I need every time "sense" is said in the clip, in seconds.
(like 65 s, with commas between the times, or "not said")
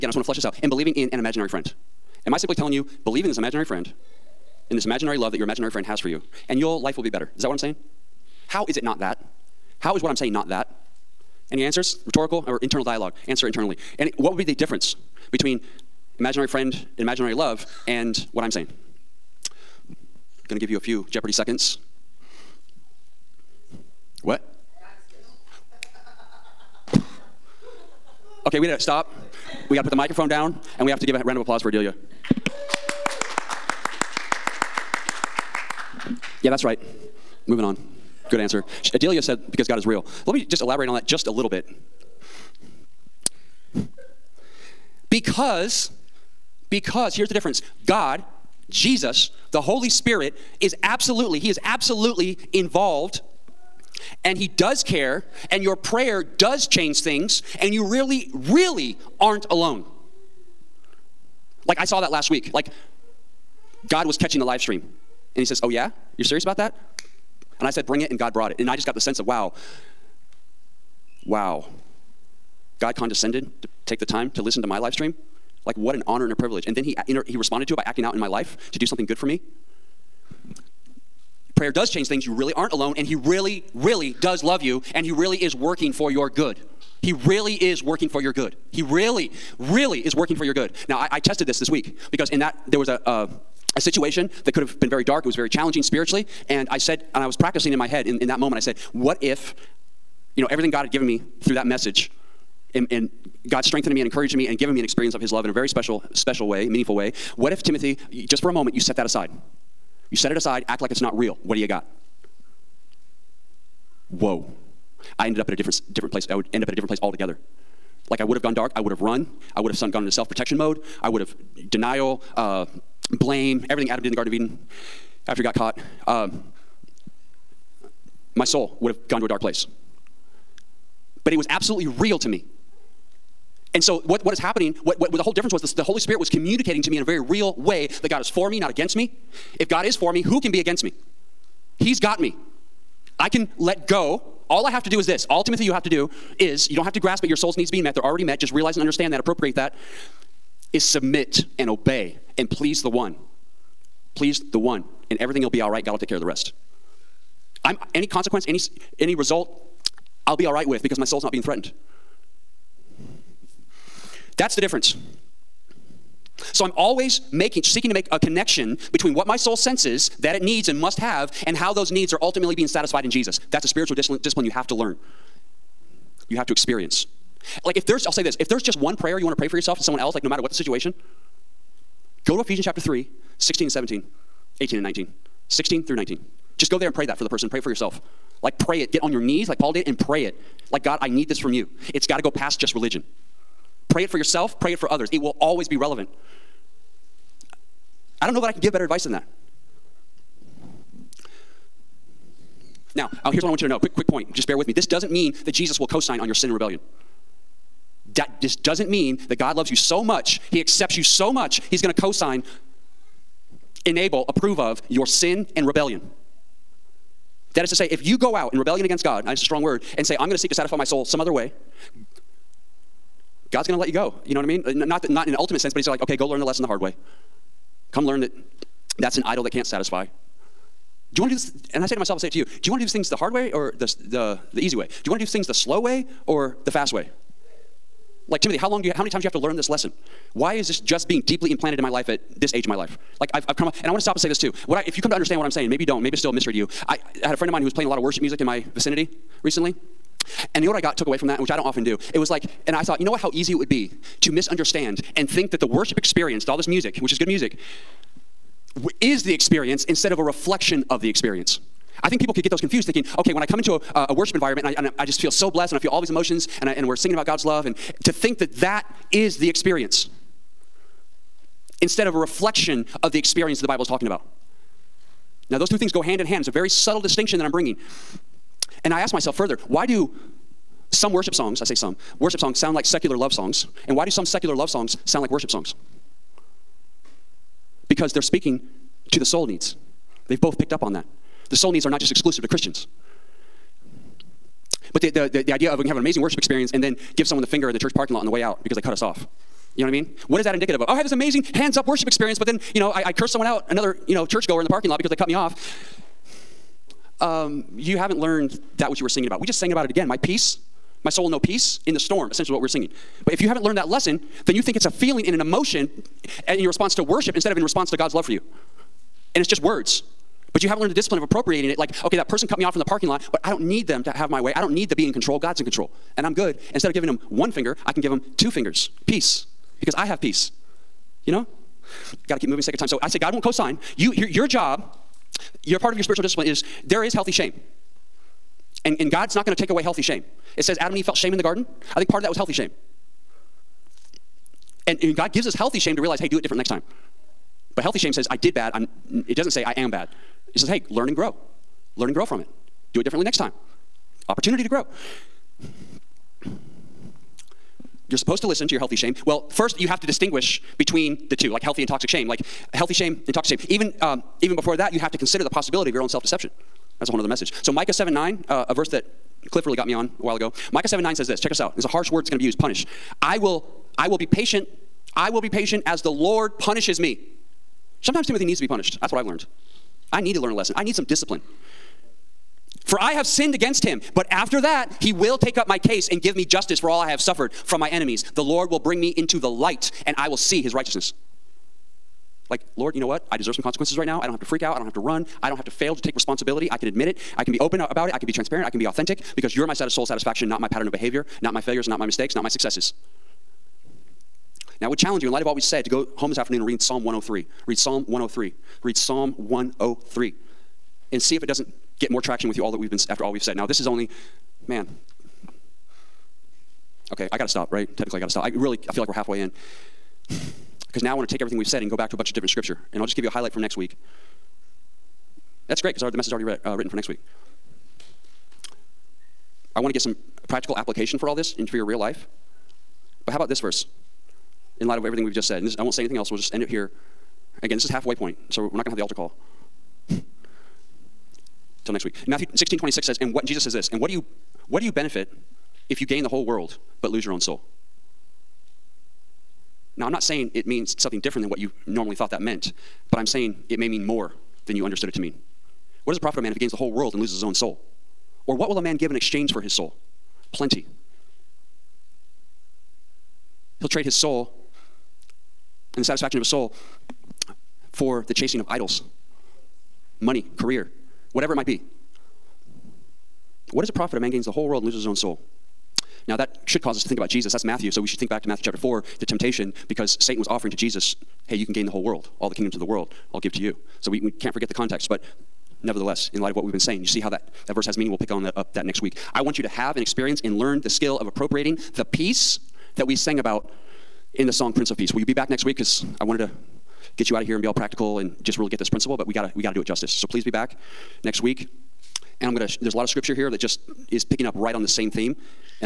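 68 s, 169 s, 225 s.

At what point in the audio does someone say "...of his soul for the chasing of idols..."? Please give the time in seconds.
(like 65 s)
466 s.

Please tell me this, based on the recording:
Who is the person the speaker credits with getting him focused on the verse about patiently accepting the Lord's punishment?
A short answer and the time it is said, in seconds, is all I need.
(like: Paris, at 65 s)
Cliff, at 369 s.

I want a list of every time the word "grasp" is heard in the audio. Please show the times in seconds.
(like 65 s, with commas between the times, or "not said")
146 s.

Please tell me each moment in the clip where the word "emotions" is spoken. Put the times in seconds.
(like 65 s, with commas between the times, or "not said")
266 s, 315 s.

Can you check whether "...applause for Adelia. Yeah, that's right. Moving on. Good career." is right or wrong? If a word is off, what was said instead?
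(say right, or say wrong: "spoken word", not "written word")
wrong: "answer", not "career".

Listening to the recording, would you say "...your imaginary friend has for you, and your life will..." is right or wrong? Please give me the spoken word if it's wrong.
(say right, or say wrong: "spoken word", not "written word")
right.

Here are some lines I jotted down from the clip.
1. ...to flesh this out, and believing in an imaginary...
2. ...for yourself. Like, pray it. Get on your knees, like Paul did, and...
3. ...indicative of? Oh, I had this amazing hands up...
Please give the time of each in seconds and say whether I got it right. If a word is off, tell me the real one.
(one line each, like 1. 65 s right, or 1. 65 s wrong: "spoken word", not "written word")
1. 0 s right
2. 187 s right
3. 300 s right.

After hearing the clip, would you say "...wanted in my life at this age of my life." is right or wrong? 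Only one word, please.
wrong.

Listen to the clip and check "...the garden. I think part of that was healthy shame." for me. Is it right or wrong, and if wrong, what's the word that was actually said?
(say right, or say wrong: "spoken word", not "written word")
right.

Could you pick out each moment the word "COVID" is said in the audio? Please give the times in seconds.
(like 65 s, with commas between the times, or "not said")
not said.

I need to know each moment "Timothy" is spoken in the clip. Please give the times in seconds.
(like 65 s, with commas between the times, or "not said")
107 s, 145 s, 238 s, 378 s.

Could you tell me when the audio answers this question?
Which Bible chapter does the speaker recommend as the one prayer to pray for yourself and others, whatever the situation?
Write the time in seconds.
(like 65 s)
182 s.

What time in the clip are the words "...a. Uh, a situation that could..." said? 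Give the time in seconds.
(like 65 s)
92 s.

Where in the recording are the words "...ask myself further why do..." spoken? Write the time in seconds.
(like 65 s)
278 s.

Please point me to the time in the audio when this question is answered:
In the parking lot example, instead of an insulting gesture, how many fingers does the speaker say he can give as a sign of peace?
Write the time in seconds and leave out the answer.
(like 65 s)
328 s.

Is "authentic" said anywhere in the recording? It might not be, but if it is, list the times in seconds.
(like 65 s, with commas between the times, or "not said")
398 s.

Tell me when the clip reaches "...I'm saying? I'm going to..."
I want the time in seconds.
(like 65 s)
18 s.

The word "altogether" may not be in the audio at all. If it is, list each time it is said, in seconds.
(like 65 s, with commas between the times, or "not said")
117 s.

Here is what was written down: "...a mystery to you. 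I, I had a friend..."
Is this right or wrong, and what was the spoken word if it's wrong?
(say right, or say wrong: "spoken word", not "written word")
right.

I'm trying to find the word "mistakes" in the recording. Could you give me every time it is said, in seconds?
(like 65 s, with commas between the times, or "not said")
402 s.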